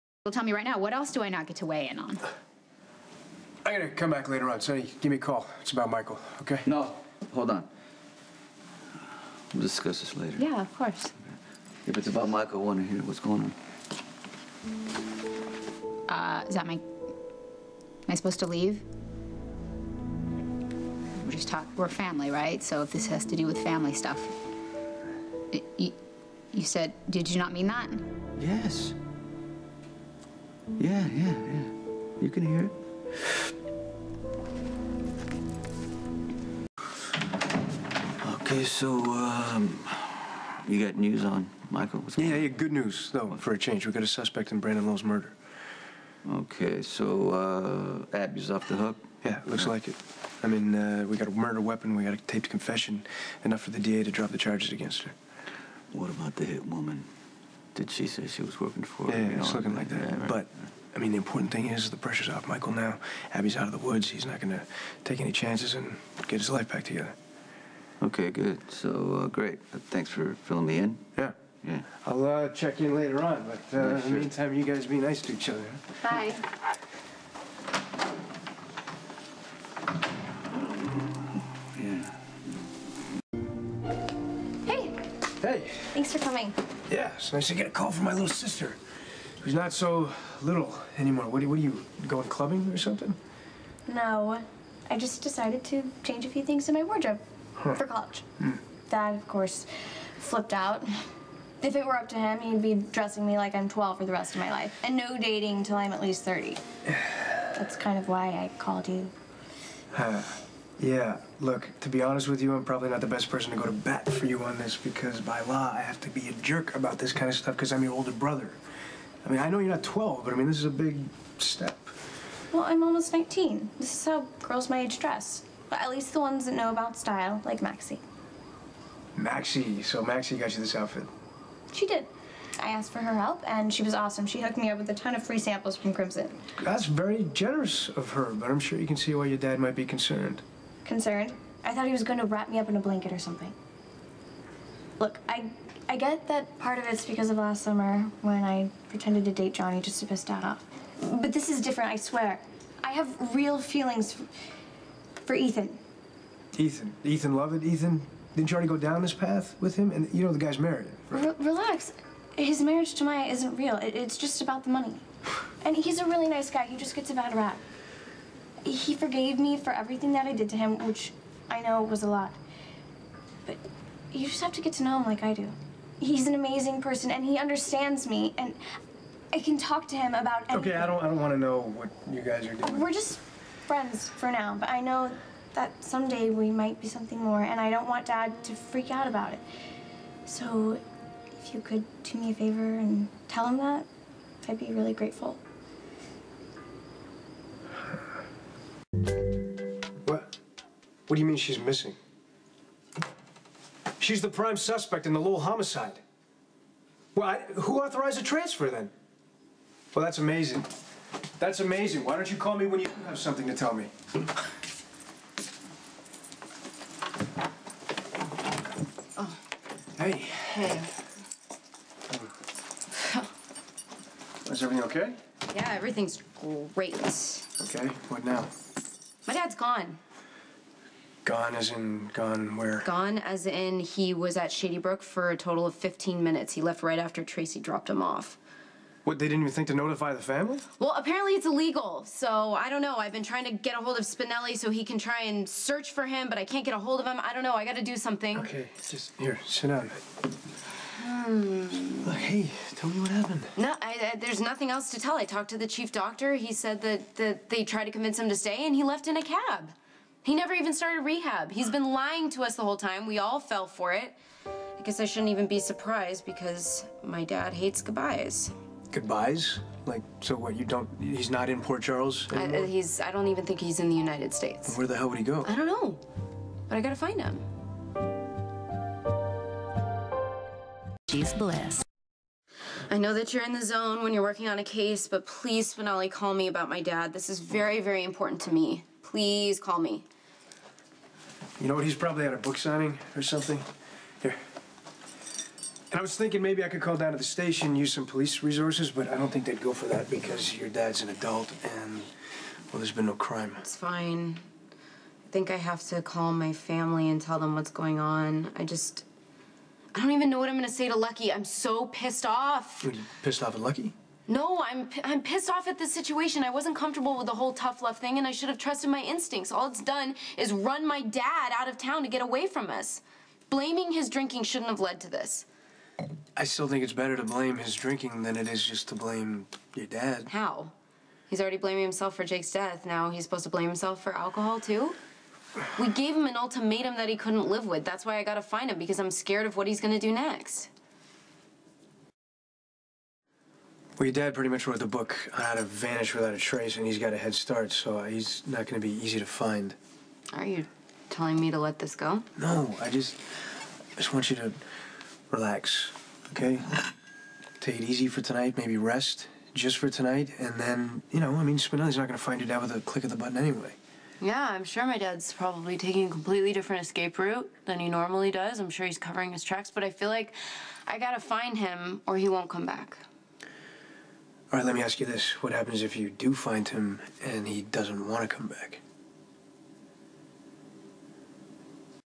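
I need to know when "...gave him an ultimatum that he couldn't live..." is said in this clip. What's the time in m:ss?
5:35.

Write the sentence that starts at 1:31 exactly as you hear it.
What are, what are you, going clubbing or something?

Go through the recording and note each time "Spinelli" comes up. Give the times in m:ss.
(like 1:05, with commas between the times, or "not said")
4:04, 4:45, 6:01.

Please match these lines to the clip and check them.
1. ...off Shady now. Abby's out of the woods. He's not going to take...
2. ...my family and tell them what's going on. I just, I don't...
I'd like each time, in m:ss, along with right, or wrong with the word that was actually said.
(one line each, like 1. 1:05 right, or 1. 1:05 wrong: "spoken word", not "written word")
1. 1:02 wrong: "Michael", not "Shady"
2. 5:06 right.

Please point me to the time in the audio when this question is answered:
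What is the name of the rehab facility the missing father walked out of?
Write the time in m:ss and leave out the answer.
3:54.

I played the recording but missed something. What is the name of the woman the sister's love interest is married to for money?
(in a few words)
Maya.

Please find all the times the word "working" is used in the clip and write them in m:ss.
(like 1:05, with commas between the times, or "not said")
0:58, 4:44.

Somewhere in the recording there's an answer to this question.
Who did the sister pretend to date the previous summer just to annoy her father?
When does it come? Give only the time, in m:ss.
2:29.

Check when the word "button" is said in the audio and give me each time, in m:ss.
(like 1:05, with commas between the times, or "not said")
6:03.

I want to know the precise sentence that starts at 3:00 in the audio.
Okay, I don't, I don't want to know what you guys are doing.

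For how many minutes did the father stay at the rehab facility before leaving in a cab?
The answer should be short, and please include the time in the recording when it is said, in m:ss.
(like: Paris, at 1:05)
15, at 3:55.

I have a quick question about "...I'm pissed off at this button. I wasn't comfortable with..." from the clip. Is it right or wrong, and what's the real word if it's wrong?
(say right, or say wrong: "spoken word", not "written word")
wrong: "situation", not "button".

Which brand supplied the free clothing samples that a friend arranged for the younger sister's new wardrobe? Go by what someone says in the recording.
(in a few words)
Crimson.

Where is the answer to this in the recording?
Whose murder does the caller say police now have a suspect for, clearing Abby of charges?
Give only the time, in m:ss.
0:44.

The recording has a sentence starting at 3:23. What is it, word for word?
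She's the prime suspect in the Lowell homicide.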